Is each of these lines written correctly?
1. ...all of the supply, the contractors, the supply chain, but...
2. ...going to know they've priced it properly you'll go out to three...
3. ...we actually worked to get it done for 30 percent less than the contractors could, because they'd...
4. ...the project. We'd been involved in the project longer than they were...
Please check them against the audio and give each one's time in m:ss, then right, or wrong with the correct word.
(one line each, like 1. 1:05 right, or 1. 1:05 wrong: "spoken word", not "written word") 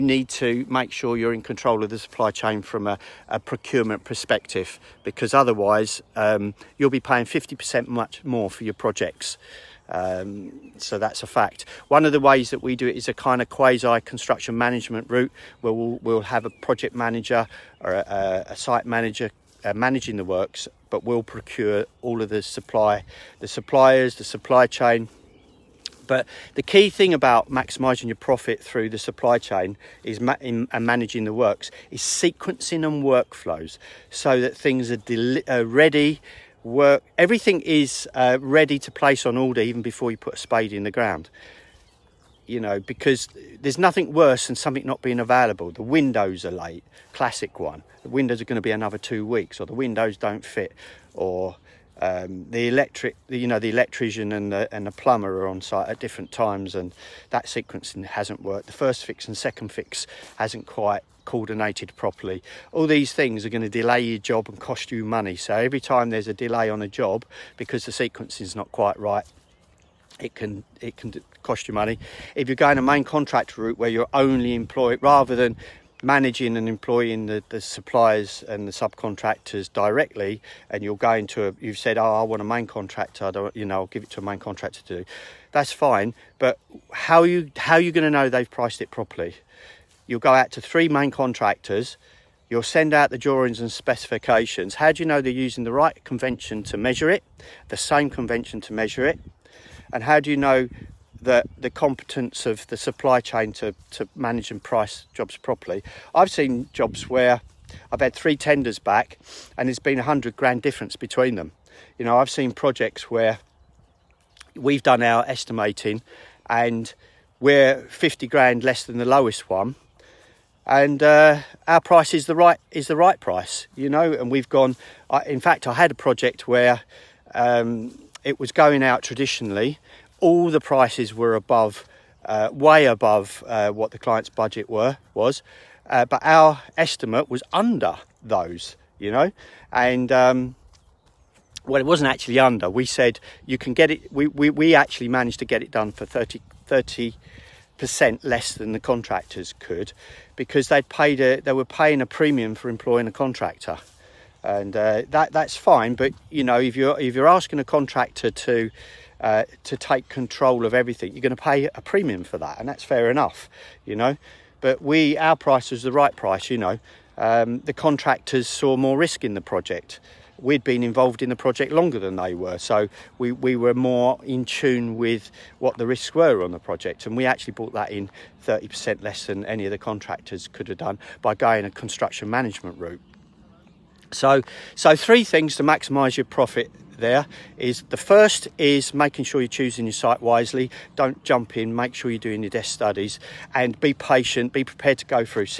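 1. 0:22 wrong: "suppliers", not "contractors"
2. 1:27 right
3. 2:24 wrong: "managed", not "worked"
4. 2:49 right.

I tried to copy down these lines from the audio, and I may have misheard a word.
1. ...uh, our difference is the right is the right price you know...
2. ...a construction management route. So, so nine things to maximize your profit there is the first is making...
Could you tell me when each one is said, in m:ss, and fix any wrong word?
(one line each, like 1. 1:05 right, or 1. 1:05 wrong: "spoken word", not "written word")
1. 2:01 wrong: "price", not "difference"
2. 3:01 wrong: "three", not "nine".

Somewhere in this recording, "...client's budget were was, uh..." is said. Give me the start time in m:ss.
2:13.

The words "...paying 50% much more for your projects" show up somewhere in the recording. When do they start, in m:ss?
0:07.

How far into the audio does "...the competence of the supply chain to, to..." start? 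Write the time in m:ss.
1:41.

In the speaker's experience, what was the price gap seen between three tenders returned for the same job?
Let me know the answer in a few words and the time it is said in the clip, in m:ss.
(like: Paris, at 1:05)
100 grand, at 1:49.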